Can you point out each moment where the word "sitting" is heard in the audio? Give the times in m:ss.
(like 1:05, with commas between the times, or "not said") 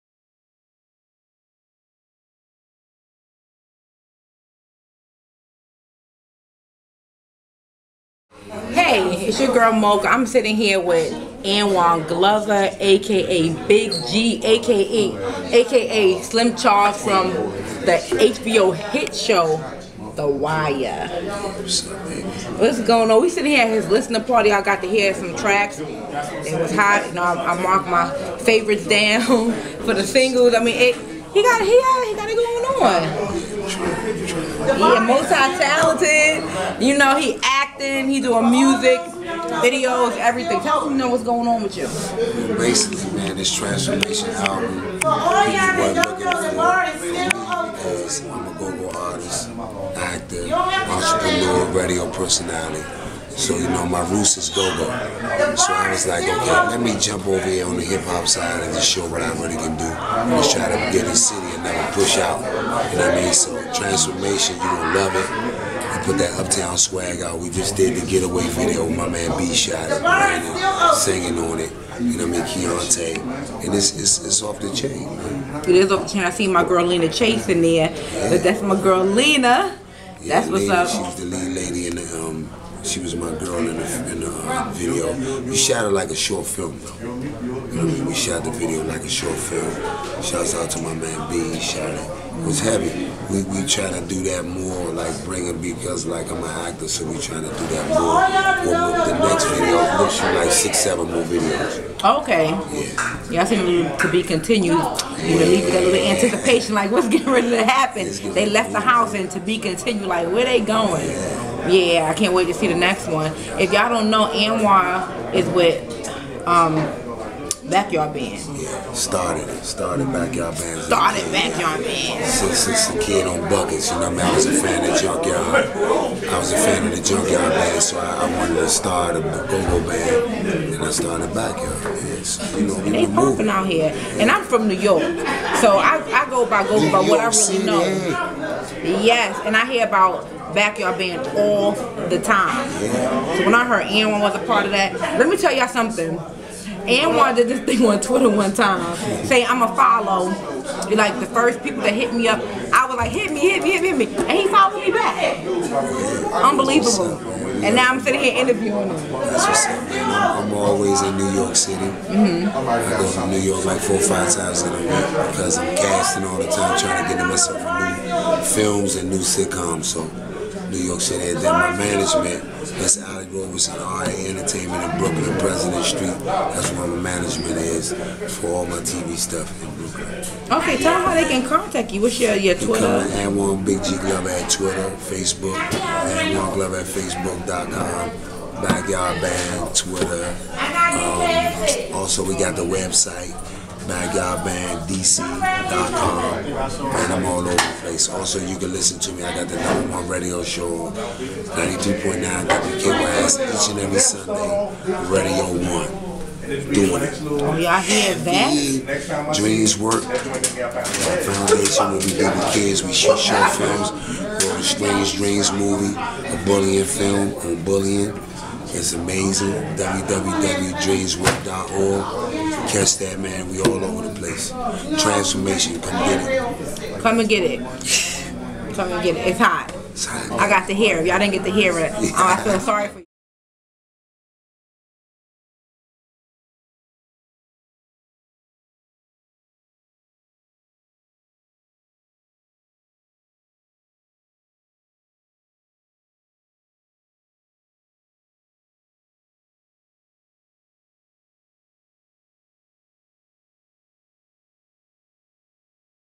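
0:10, 0:23, 2:37.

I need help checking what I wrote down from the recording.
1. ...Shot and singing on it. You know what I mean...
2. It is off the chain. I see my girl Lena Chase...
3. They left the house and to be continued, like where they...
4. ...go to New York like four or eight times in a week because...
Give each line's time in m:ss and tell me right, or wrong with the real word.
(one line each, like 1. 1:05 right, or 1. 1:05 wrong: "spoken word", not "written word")
1. 1:09 right
2. 1:15 right
3. 1:48 right
4. 2:42 wrong: "five", not "eight".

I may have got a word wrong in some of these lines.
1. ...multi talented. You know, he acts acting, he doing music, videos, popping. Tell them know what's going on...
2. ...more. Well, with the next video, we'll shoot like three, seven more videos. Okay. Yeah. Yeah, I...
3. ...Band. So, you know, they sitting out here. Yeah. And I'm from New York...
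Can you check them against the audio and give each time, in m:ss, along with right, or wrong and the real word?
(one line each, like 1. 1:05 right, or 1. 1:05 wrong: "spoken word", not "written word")
1. 0:35 wrong: "everything", not "popping"
2. 1:37 wrong: "six", not "three"
3. 2:11 wrong: "popping", not "sitting".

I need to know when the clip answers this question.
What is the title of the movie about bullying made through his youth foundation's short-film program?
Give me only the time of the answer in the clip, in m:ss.
3:34.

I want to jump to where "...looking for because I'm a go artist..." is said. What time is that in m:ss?
0:45.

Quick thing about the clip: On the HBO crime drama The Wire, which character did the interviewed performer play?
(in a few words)
Slim Charles.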